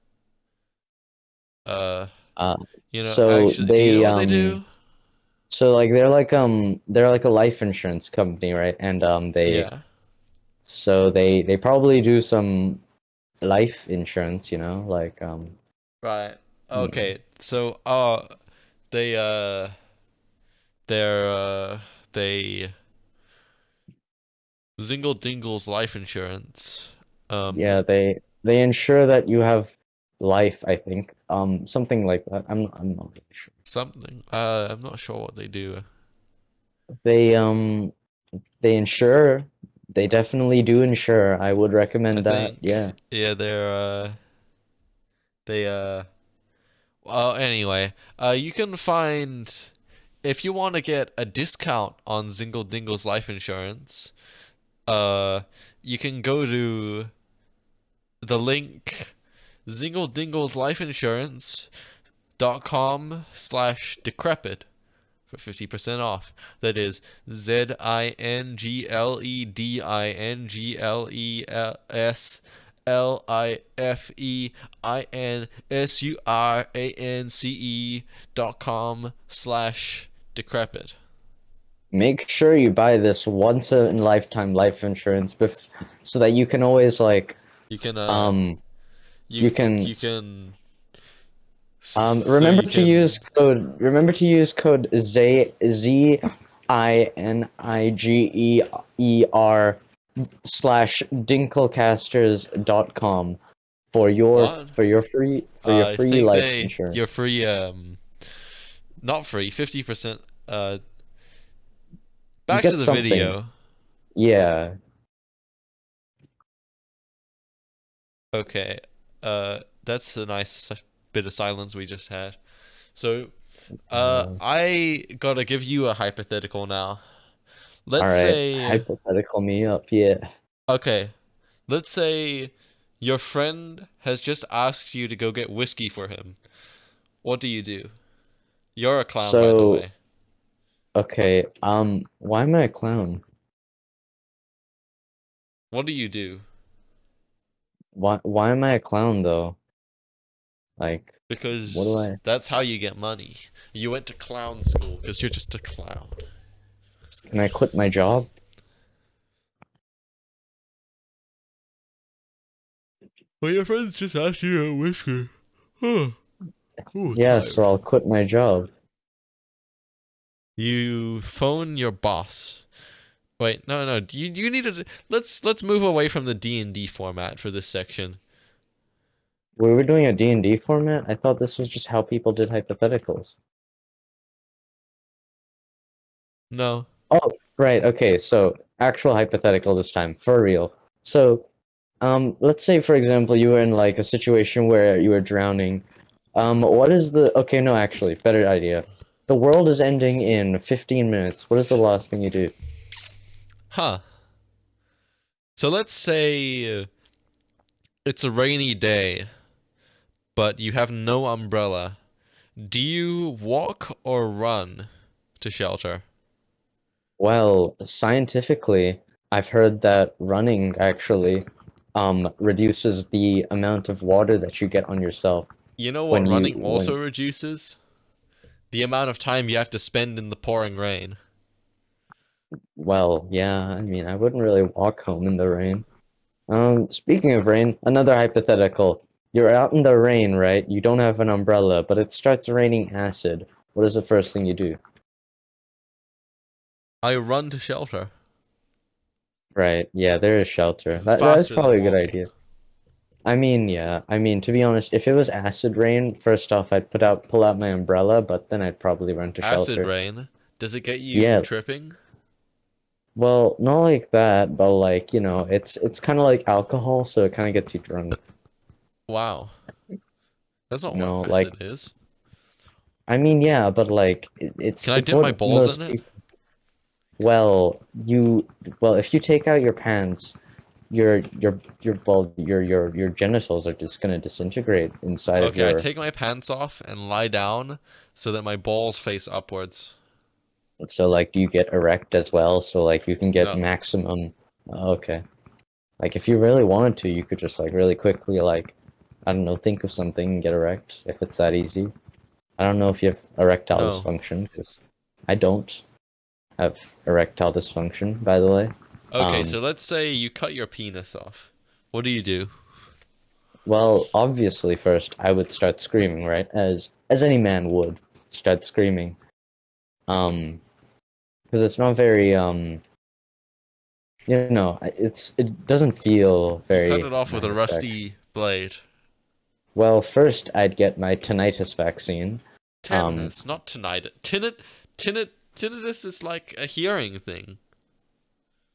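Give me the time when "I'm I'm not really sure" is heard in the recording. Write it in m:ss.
0:32.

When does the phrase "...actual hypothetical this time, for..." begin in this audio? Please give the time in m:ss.
3:08.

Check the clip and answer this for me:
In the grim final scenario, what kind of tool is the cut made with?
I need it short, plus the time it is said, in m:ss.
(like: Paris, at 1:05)
rusty blade, at 5:27.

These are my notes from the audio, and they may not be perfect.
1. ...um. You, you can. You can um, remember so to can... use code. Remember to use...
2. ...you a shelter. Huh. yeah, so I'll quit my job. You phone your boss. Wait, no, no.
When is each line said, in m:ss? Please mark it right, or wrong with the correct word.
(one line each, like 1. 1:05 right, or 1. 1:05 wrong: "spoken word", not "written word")
1. 1:28 right
2. 2:44 wrong: "whisker", not "shelter".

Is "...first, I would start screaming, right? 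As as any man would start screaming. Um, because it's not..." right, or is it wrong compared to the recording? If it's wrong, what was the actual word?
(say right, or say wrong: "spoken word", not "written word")
right.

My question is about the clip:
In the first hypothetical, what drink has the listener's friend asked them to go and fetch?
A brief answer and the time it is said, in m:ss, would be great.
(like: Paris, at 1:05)
whiskey, at 2:15.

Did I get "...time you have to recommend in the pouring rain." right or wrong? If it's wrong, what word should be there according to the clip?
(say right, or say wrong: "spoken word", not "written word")
wrong: "spend", not "recommend".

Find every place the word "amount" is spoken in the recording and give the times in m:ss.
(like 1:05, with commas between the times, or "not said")
3:43, 3:48.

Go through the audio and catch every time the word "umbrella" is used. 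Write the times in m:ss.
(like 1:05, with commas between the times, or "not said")
3:31, 4:01, 4:17.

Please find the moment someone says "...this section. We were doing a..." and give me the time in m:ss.
2:57.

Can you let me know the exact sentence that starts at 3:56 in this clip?
Um, speaking of rain, another hypothetical.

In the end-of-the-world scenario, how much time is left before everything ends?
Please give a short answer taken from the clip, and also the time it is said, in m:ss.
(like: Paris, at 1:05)
15 minutes, at 3:20.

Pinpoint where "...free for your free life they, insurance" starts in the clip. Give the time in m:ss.
1:45.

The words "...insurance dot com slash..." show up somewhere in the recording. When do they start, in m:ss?
1:00.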